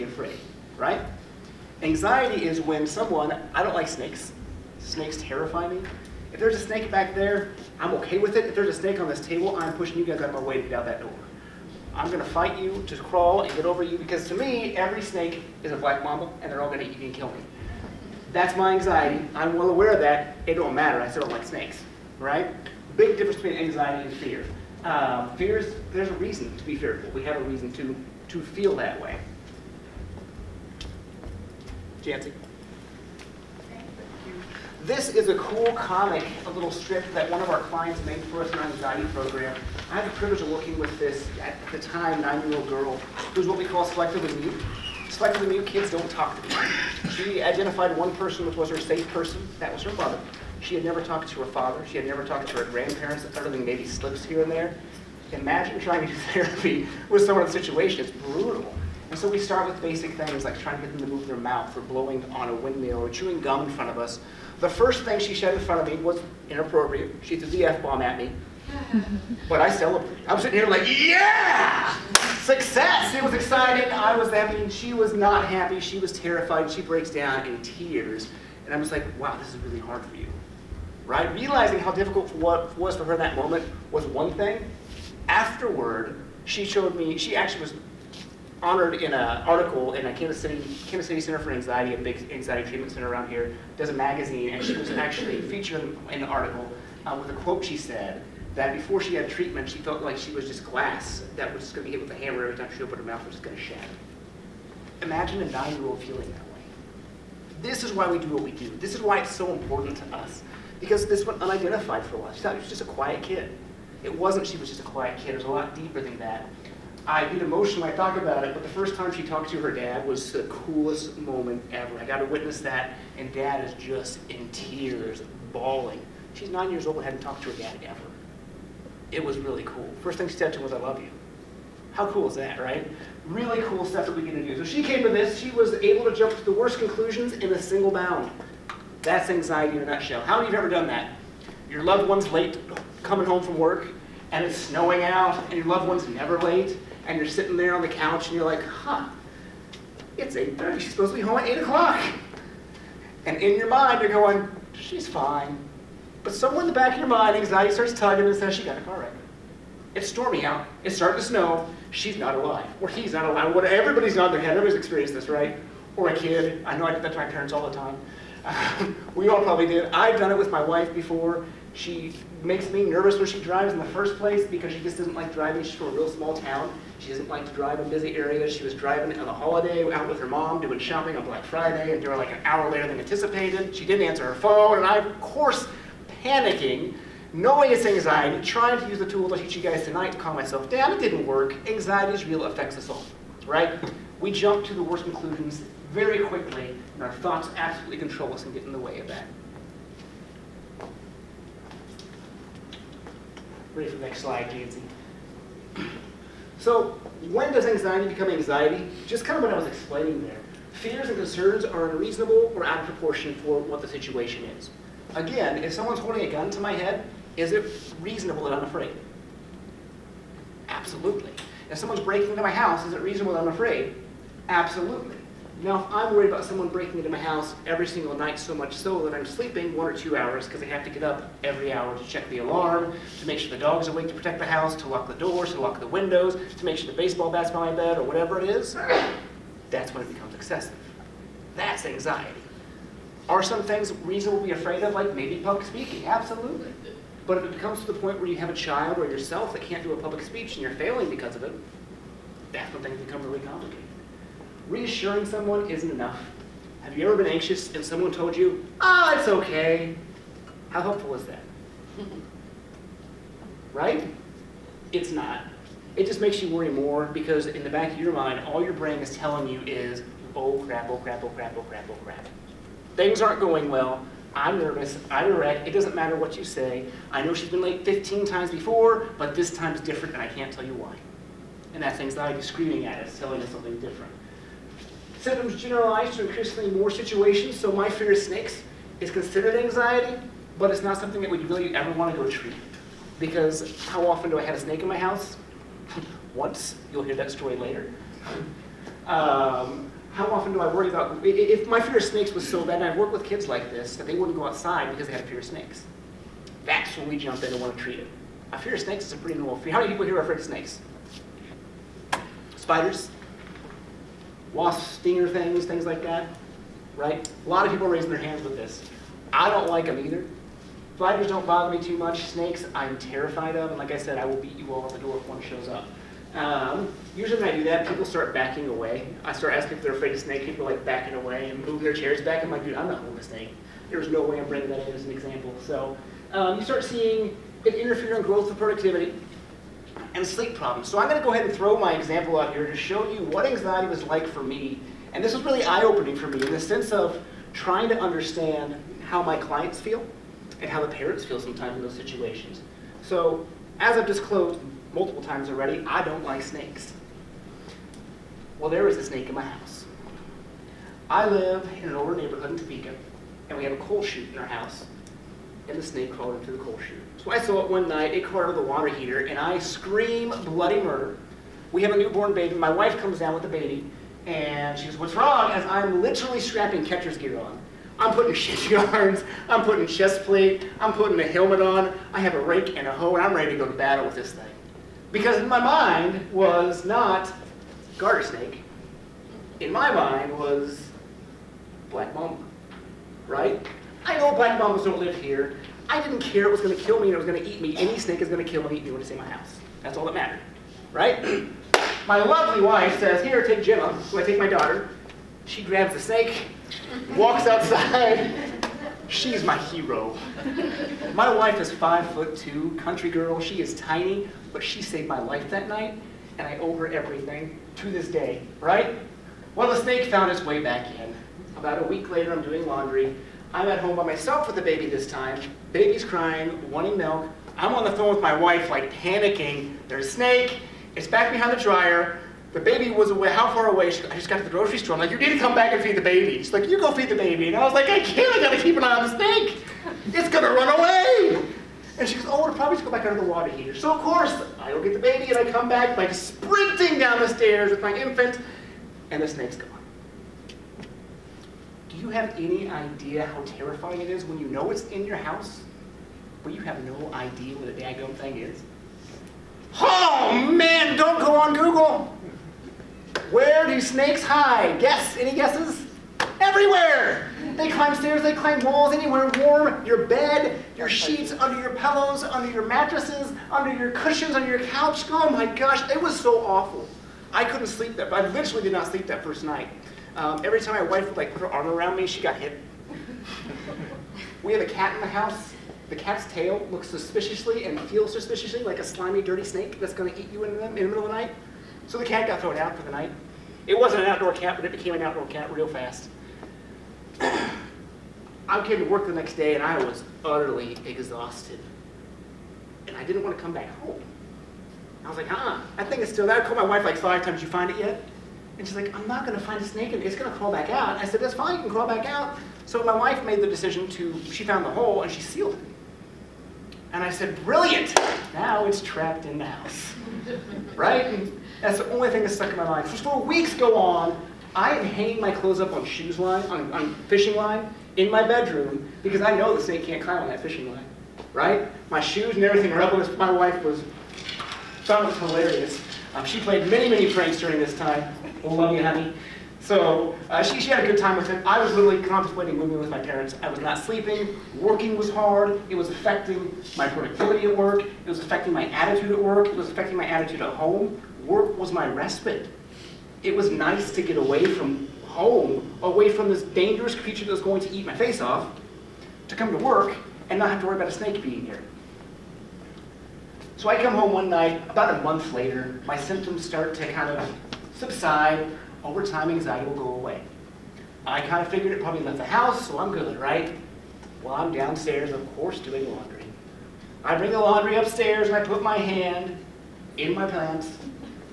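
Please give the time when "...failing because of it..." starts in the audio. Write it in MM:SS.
04:10.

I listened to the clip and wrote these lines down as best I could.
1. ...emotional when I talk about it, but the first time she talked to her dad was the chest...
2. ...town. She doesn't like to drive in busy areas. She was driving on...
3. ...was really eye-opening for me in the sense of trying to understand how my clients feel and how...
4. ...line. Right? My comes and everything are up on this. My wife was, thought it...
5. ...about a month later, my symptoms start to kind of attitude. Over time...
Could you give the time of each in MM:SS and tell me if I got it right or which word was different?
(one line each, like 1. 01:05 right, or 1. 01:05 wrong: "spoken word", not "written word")
1. 01:57 wrong: "coolest", not "chest"
2. 02:56 right
3. 05:45 right
4. 08:50 wrong: "shoes", not "comes"
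5. 09:24 wrong: "subside", not "attitude".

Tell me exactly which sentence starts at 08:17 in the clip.
I came to work the next day and I was utterly exhausted.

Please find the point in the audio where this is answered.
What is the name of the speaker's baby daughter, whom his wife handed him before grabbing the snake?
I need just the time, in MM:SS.
06:43.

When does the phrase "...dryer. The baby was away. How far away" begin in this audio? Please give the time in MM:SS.
07:11.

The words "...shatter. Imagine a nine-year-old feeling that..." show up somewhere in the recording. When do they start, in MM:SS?
01:43.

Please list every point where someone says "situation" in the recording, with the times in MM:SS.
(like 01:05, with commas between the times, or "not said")
00:57, 03:33, 04:46, 05:51.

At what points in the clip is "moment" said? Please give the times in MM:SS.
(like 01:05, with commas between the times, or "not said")
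01:23, 02:01.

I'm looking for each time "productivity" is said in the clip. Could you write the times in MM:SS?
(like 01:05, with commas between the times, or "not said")
05:38, 09:06.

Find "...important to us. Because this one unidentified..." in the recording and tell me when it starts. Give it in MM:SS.
01:49.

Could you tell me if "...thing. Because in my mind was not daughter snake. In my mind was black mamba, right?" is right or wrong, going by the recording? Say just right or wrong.
wrong.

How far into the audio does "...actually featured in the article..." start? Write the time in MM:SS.
01:34.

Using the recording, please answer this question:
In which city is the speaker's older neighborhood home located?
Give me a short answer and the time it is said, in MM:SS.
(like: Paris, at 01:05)
Topeka, at 06:02.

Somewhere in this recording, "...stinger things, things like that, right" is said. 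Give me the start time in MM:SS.
05:14.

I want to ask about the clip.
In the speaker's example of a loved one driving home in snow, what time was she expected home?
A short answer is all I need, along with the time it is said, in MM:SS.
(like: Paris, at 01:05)
8 o'clock, at 02:31.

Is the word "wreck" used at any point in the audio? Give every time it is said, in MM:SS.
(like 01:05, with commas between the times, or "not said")
02:38, 04:35.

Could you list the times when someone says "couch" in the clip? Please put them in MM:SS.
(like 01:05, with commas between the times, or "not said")
02:27, 07:54.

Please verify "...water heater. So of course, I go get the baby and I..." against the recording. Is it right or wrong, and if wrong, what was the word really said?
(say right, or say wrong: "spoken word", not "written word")
right.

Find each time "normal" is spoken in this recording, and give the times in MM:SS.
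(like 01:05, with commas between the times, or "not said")
05:09.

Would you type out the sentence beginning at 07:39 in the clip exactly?
Oh man, don't go on Google!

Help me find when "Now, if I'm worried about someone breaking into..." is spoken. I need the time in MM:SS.
03:45.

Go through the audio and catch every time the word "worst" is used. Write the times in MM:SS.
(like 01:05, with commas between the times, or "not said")
02:16, 03:14.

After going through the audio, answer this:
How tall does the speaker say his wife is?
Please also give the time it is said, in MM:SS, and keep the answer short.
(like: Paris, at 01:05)
5 foot 2, at 06:51.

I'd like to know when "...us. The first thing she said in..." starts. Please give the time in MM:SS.
01:03.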